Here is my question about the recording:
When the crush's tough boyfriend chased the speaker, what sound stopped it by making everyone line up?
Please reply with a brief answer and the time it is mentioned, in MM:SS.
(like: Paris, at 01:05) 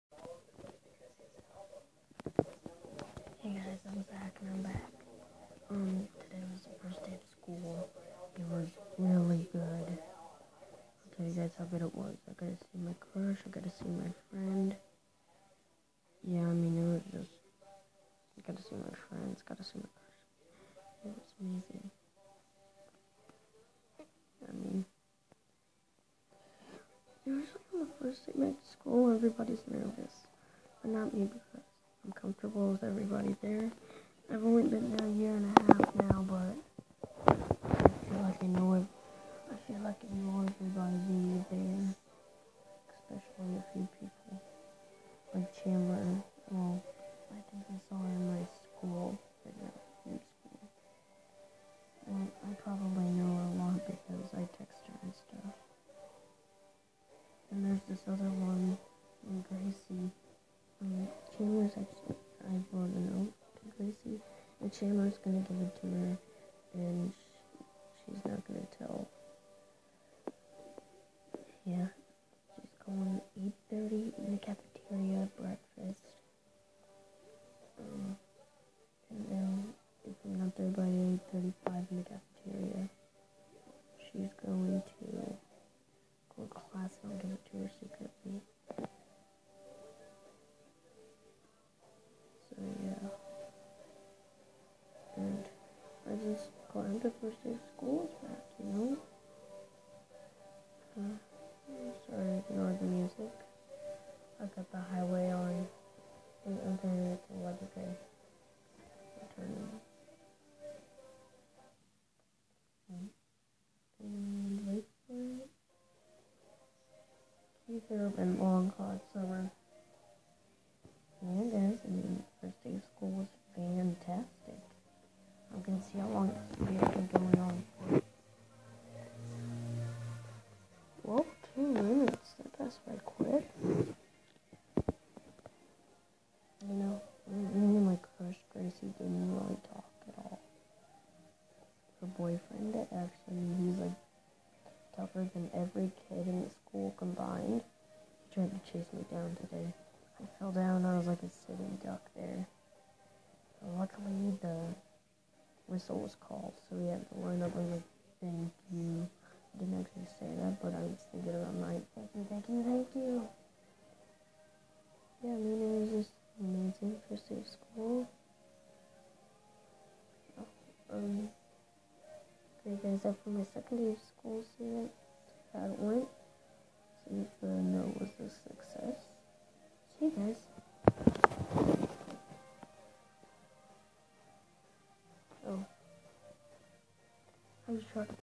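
Whistle, at 02:35.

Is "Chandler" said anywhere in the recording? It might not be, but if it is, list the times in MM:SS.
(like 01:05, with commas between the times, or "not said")
00:45, 01:04.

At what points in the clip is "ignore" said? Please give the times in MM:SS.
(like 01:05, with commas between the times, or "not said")
01:42.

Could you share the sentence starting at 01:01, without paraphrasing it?
I brought a note to Gracie.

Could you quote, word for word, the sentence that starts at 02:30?
I was like a sitting duck there.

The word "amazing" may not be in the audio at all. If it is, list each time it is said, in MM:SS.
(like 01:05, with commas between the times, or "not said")
00:21, 02:46.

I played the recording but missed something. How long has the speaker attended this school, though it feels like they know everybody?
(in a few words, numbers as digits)
A year and a half.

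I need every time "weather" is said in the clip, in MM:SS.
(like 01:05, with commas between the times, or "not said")
01:47.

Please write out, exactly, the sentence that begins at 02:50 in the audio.
Oh, um, great guys up for my second day of school student how it went.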